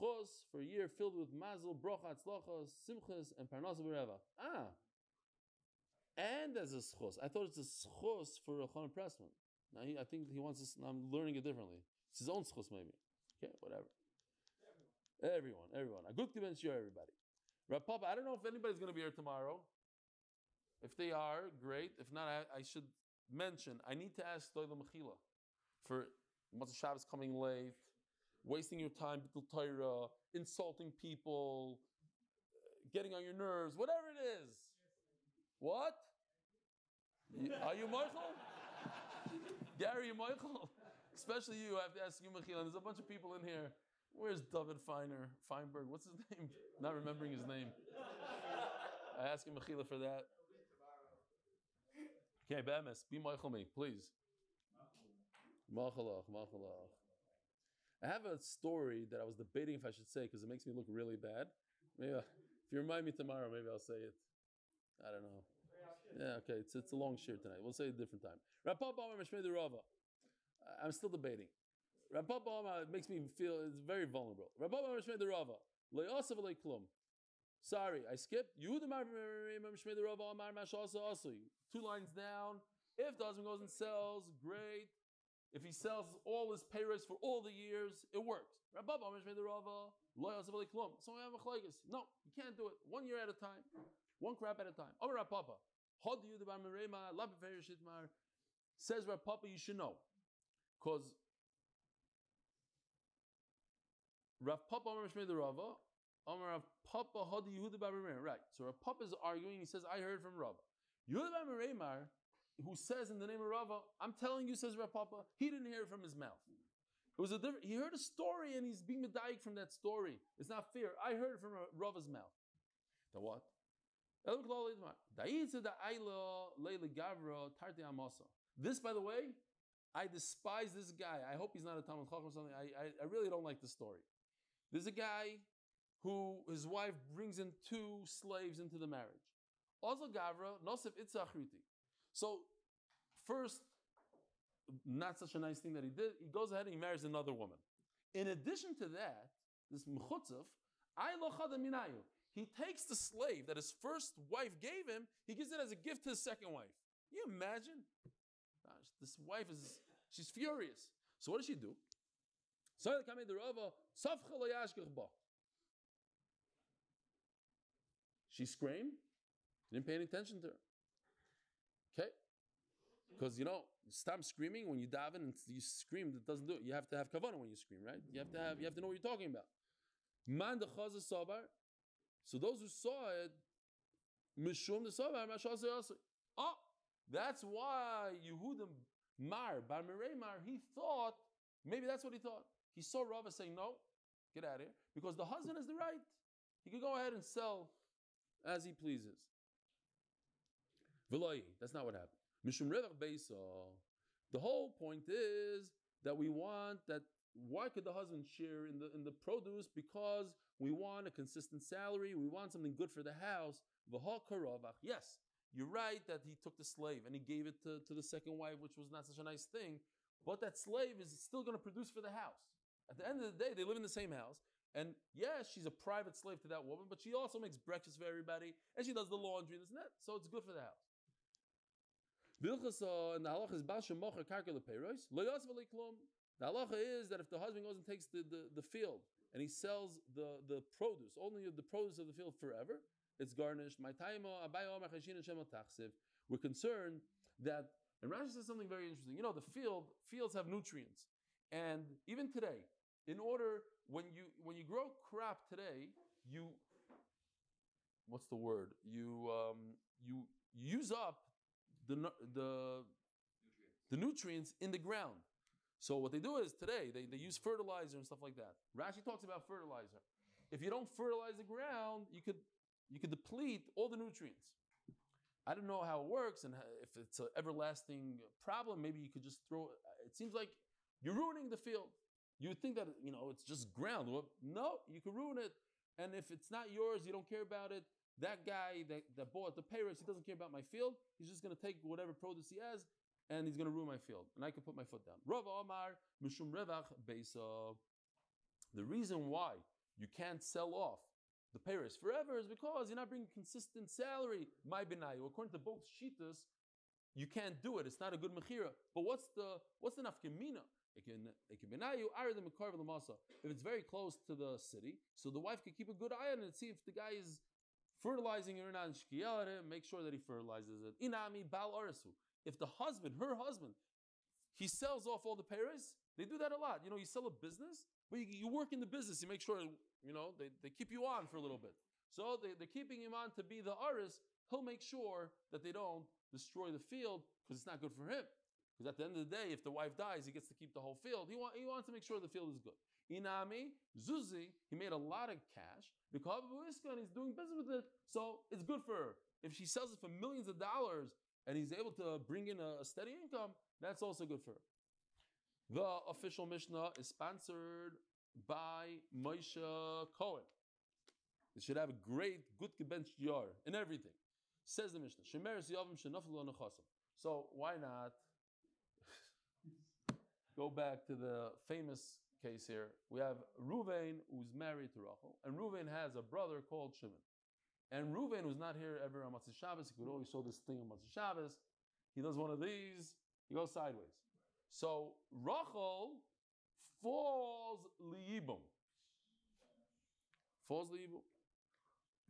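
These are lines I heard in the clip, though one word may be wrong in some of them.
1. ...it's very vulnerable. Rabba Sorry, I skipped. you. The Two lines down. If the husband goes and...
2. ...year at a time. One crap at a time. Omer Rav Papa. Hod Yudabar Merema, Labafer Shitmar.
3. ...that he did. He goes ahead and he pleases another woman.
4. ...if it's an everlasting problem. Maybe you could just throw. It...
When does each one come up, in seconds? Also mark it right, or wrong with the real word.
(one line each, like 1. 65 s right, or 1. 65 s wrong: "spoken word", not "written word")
1. 73 s right
2. 93 s right
3. 145 s wrong: "marries", not "pleases"
4. 276 s right.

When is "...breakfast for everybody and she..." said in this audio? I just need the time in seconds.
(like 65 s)
227 s.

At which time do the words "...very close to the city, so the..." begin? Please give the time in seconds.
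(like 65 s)
313 s.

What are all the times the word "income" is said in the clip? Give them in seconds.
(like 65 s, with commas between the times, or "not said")
353 s.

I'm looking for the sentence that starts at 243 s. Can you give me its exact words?
We're concerned that, and Rashi says something very interesting.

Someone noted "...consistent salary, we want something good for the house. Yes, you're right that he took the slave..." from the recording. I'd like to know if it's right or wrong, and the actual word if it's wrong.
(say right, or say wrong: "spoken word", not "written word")
right.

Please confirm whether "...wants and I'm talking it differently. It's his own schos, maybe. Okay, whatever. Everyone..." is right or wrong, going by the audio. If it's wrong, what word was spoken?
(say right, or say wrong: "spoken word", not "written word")
wrong: "learning", not "talking".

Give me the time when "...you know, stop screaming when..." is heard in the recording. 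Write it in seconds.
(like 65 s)
173 s.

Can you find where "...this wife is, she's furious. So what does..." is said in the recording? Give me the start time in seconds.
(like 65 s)
158 s.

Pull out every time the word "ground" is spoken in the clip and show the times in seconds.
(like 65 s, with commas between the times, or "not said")
264 s, 271 s, 283 s.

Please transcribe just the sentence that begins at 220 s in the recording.
But that slave is still going to produce for the house.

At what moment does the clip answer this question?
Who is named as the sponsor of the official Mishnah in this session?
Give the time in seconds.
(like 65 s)
359 s.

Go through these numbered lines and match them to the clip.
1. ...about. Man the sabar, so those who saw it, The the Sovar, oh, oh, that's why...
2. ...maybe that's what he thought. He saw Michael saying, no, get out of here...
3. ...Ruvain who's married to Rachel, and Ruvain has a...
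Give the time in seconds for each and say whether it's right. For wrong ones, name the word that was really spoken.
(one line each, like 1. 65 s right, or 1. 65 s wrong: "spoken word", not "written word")
1. 179 s wrong: "Mishum", not "The"
2. 191 s wrong: "Rava", not "Michael"
3. 373 s right.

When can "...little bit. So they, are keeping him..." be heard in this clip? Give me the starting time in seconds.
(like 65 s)
331 s.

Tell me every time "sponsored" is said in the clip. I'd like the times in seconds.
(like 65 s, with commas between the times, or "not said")
357 s.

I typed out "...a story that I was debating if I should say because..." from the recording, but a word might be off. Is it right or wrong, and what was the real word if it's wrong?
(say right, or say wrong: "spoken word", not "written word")
right.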